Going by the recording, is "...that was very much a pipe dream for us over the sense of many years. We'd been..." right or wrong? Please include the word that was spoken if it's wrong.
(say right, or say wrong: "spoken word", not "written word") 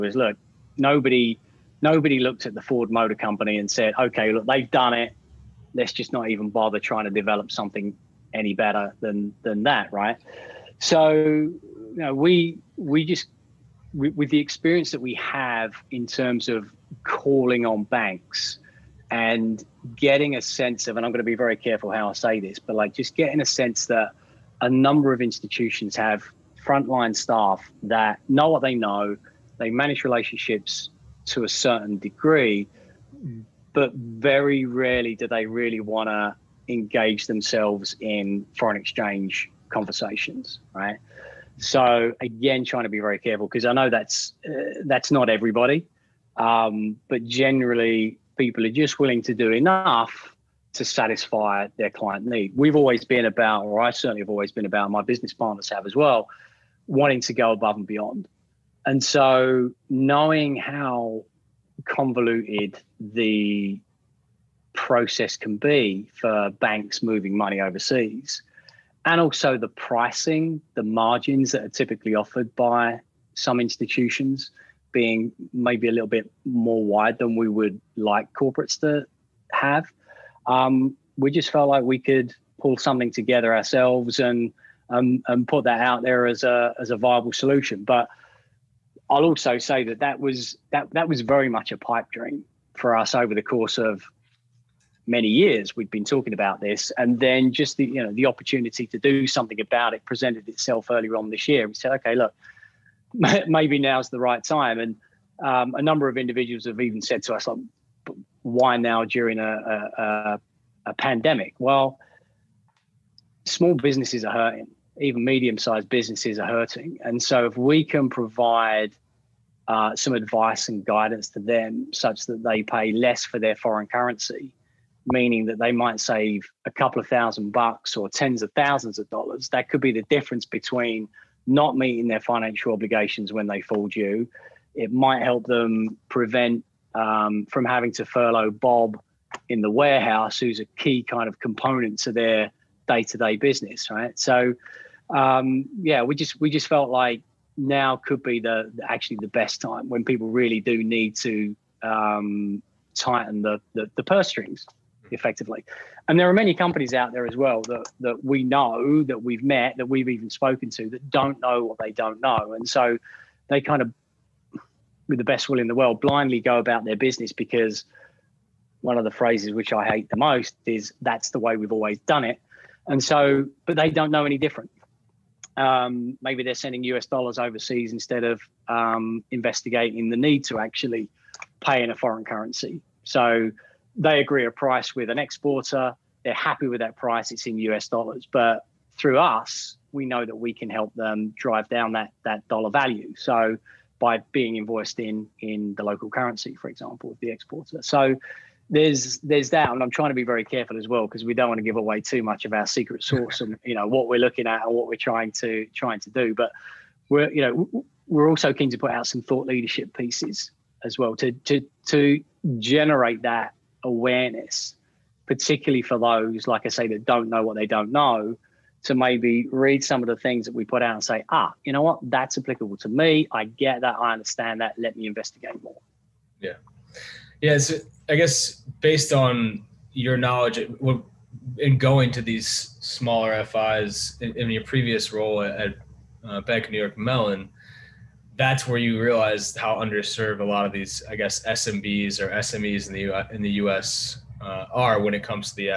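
wrong: "course", not "sense".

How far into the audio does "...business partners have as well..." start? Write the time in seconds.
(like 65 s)
54 s.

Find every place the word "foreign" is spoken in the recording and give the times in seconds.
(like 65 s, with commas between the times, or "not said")
38 s, 123 s, 181 s.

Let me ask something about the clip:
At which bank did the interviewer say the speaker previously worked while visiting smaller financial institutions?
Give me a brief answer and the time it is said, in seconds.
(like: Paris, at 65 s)
Bank of New York Mellon, at 236 s.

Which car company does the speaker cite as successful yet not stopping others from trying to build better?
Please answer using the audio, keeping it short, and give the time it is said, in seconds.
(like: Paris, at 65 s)
Ford Motor Company, at 2 s.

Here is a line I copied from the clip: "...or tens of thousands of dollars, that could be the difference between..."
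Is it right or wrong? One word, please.
right.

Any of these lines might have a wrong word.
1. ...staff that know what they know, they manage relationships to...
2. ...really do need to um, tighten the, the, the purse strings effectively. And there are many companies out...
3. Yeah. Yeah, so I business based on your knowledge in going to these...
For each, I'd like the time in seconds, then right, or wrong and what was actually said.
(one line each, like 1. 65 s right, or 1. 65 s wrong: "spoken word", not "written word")
1. 27 s right
2. 150 s right
3. 226 s wrong: "guess", not "business".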